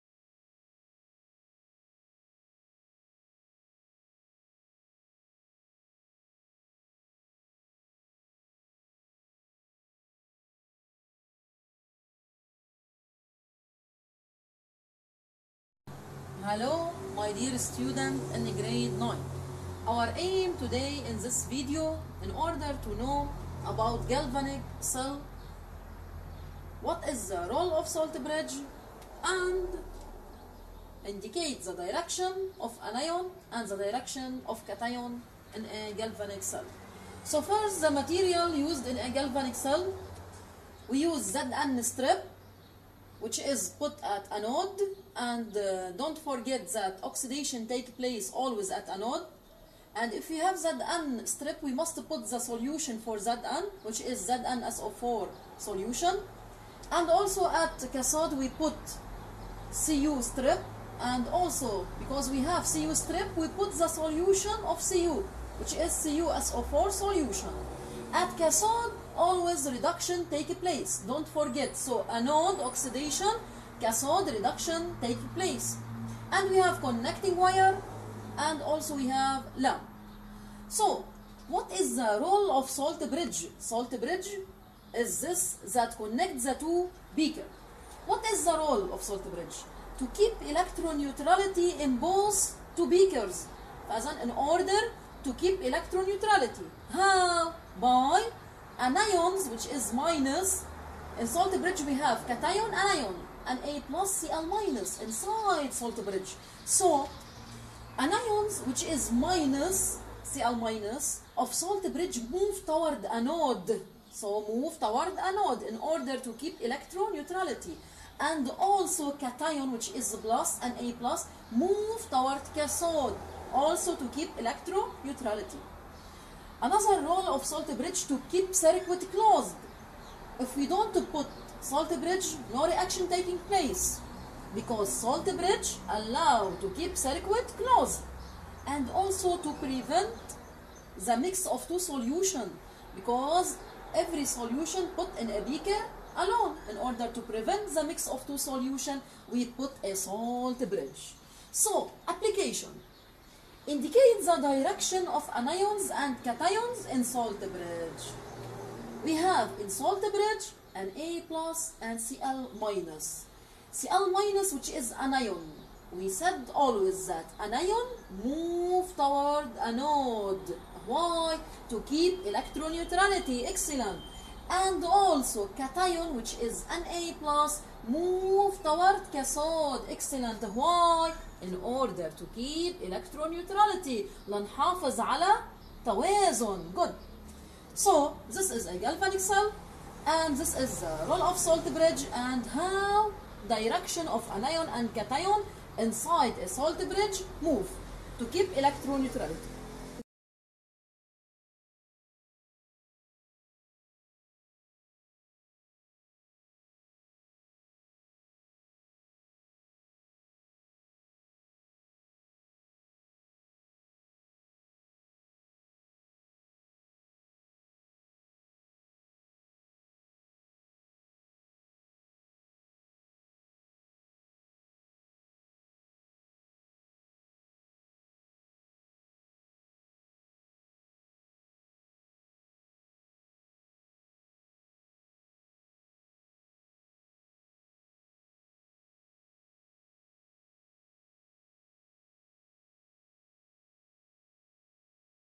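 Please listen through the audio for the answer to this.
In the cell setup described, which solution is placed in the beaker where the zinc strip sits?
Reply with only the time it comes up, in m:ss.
0:54.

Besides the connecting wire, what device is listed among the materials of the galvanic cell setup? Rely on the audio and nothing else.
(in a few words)
lamp.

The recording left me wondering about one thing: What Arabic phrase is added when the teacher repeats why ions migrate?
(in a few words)
لنحافظ على توازن.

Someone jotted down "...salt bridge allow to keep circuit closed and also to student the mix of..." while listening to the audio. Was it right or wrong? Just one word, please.
wrong.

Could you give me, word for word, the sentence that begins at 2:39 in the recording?
We have in salt bridge Na plus and Cl minus.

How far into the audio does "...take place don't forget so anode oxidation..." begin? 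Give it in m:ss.
1:10.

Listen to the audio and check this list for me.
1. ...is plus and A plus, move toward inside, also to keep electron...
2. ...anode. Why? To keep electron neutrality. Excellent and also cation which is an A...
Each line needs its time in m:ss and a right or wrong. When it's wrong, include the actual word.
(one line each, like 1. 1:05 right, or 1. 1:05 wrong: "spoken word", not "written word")
1. 1:59 wrong: "cathode", not "inside"
2. 2:49 right.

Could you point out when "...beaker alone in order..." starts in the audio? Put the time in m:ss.
2:25.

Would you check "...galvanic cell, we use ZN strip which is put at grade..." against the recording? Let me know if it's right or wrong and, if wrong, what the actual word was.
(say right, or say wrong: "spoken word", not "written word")
wrong: "anode", not "grade".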